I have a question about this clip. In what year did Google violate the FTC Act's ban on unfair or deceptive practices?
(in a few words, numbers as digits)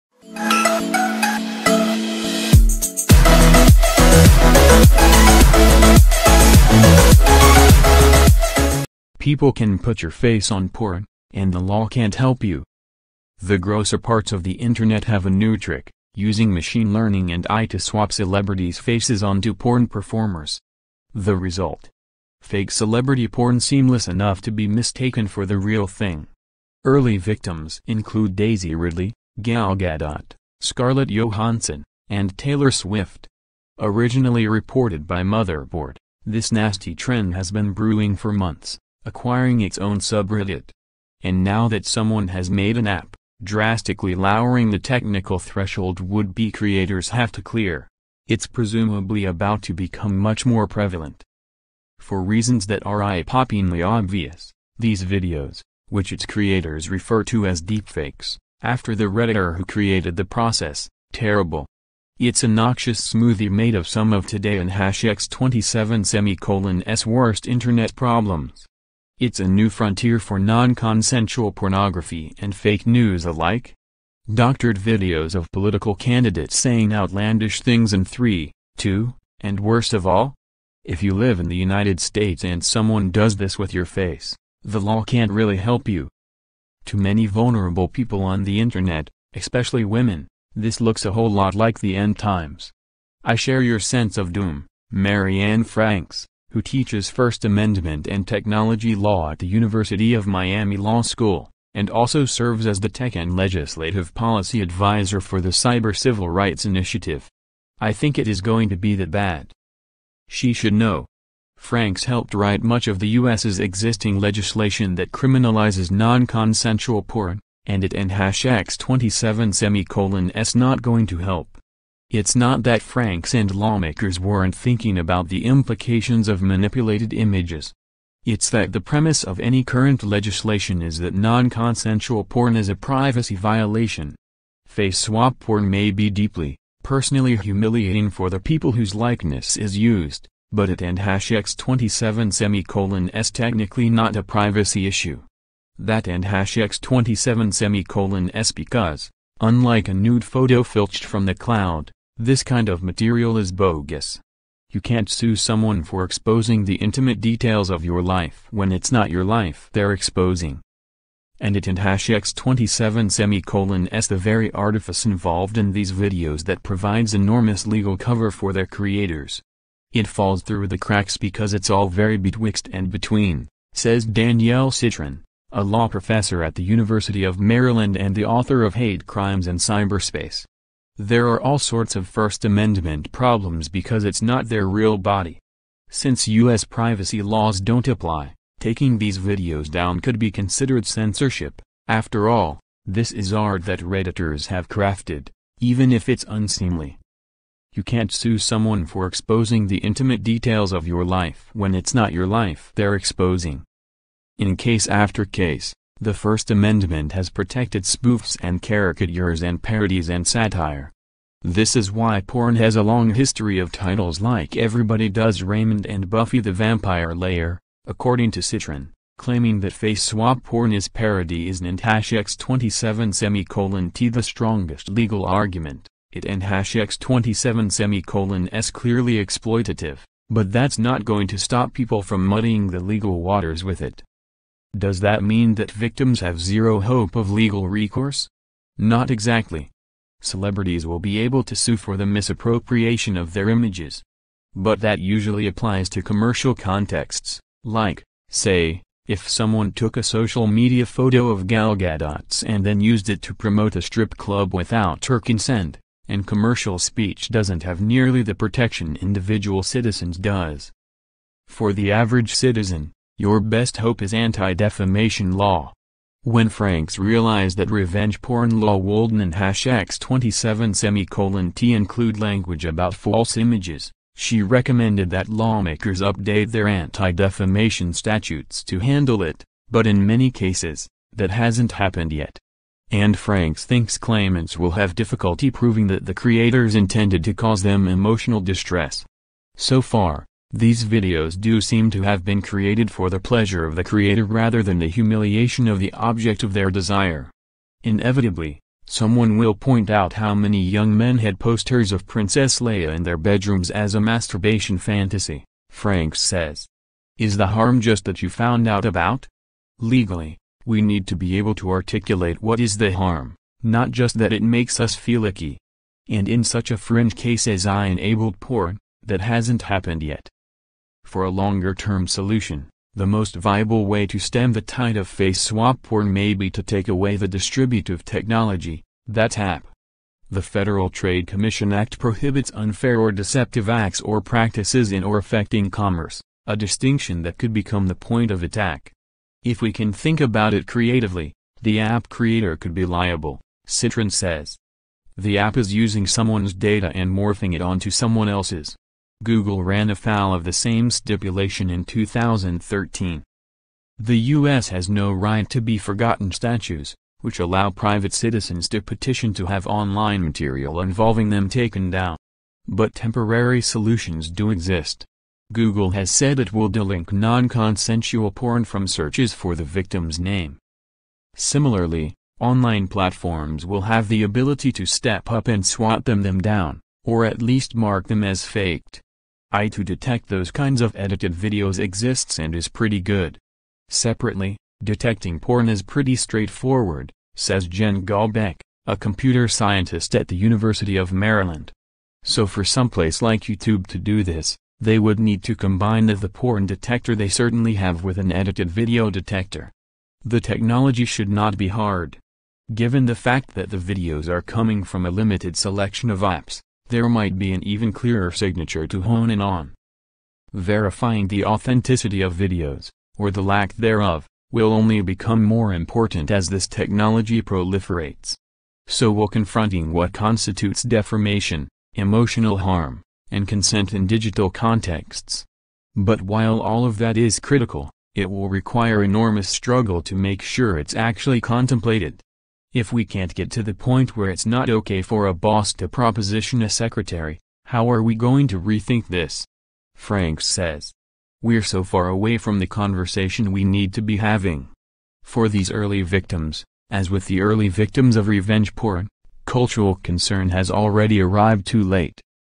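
2013.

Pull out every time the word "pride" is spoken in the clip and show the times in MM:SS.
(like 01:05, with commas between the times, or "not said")
not said.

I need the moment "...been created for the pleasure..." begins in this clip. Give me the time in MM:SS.
04:52.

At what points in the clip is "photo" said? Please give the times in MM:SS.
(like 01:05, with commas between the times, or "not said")
02:30, 04:10.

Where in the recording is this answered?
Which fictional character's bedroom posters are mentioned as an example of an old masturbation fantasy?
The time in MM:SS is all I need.
05:02.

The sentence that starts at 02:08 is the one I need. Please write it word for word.
It's that the premise of any current legislation is that non-consensual porn is a privacy violation.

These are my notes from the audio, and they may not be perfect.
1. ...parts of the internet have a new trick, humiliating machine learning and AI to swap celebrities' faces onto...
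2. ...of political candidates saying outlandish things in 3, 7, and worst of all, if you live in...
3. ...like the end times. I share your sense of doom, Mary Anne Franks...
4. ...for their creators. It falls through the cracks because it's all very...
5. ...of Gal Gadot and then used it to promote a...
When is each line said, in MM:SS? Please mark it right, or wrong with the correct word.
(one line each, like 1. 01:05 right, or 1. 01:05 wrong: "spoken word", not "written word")
1. 00:13 wrong: "using", not "humiliating"
2. 01:15 wrong: "2", not "7"
3. 01:31 right
4. 02:48 right
5. 04:11 right.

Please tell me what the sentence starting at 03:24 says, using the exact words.
In case after case, the First Amendment has protected spoofs and caricatures and parodies and satire.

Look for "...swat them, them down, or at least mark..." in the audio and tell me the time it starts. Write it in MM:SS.
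06:15.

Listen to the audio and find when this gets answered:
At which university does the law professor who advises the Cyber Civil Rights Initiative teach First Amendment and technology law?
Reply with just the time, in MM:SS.
01:39.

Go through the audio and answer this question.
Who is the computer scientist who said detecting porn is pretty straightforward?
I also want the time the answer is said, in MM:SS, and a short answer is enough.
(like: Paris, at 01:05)
Jen Golbeck, at 06:27.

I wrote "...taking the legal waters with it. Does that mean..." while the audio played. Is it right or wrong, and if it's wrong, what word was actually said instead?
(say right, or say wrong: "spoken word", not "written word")
wrong: "muddying", not "taking".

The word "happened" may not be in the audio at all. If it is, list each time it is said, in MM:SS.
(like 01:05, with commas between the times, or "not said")
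04:41, 05:19.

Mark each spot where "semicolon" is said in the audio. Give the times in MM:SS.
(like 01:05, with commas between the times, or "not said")
01:06, 01:59, 02:22, 02:27, 02:43, 03:43, 03:47, 04:30.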